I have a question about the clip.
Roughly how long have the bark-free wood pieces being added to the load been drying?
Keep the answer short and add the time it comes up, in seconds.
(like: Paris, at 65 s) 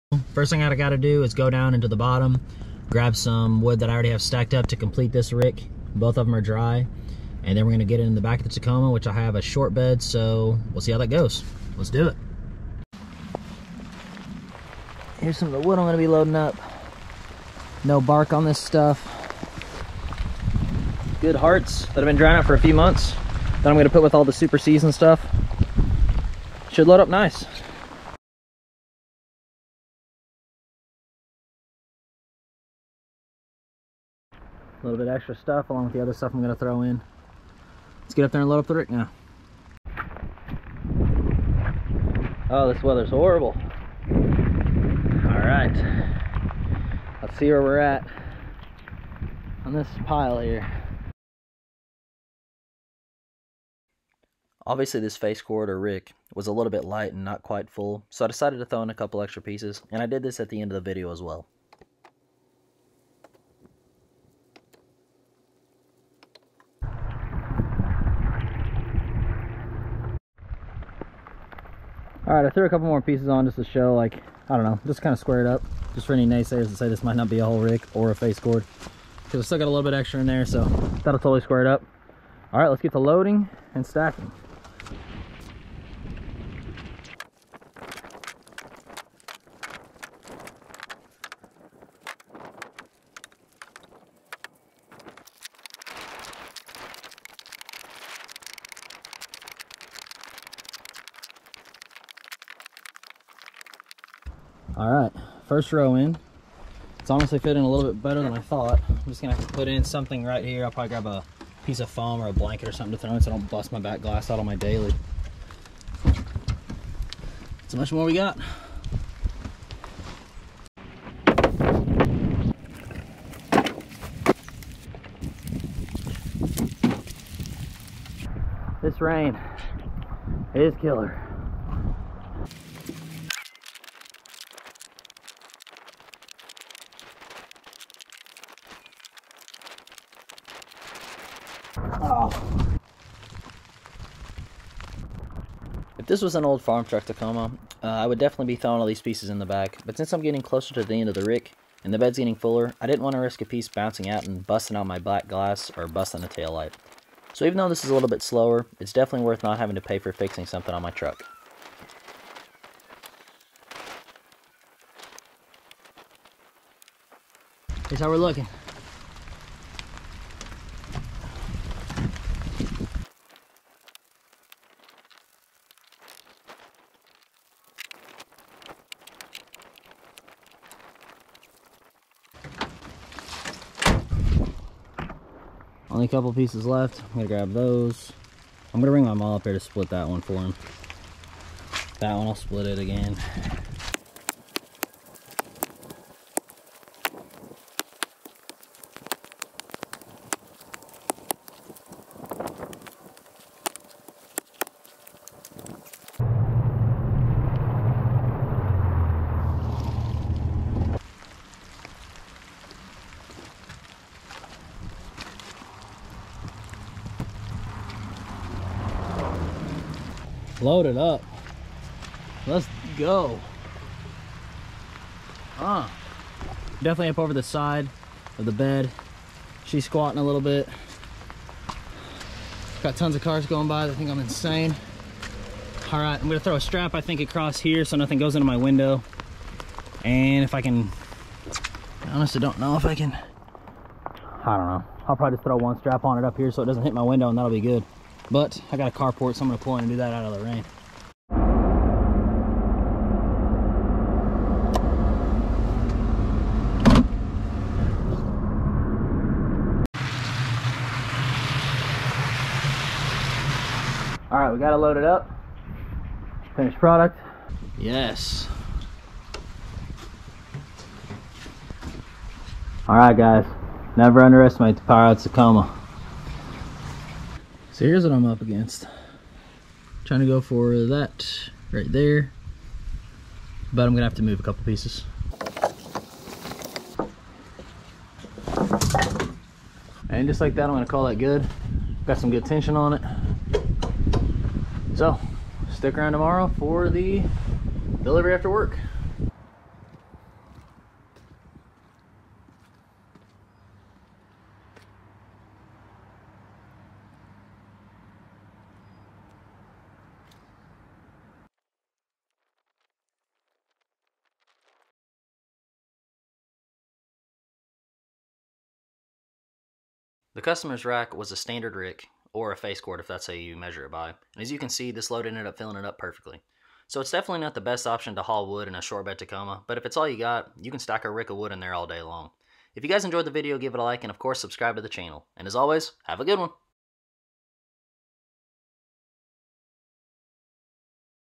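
A few months, at 22 s.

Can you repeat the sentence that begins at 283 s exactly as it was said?
But I'm gonna have to move a couple pieces.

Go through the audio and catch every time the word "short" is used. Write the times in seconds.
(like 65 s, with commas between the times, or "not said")
9 s, 328 s.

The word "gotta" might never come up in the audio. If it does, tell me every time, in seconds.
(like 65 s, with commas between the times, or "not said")
0 s.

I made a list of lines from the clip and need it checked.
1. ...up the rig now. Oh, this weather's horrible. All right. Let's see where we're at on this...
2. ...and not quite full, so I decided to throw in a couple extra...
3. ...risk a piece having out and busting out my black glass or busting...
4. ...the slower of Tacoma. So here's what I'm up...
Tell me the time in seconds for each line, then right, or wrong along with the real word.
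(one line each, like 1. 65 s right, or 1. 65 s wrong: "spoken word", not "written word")
1. 38 s right
2. 57 s right
3. 153 s wrong: "bouncing", not "having"
4. 274 s wrong: "power", not "slower".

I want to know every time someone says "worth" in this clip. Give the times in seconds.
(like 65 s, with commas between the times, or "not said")
159 s.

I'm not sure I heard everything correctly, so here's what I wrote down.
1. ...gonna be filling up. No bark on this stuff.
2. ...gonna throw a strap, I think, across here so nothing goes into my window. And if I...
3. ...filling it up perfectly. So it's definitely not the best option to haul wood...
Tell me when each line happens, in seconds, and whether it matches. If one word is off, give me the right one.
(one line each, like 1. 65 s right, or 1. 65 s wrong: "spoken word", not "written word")
1. 15 s wrong: "loading", not "filling"
2. 236 s right
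3. 325 s right.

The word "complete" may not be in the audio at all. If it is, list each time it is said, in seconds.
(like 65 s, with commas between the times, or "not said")
4 s.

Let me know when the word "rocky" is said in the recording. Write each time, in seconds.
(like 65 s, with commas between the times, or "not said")
not said.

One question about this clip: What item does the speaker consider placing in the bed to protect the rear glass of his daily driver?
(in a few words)
Foam or a blanket.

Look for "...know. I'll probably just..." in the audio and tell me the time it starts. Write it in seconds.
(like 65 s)
244 s.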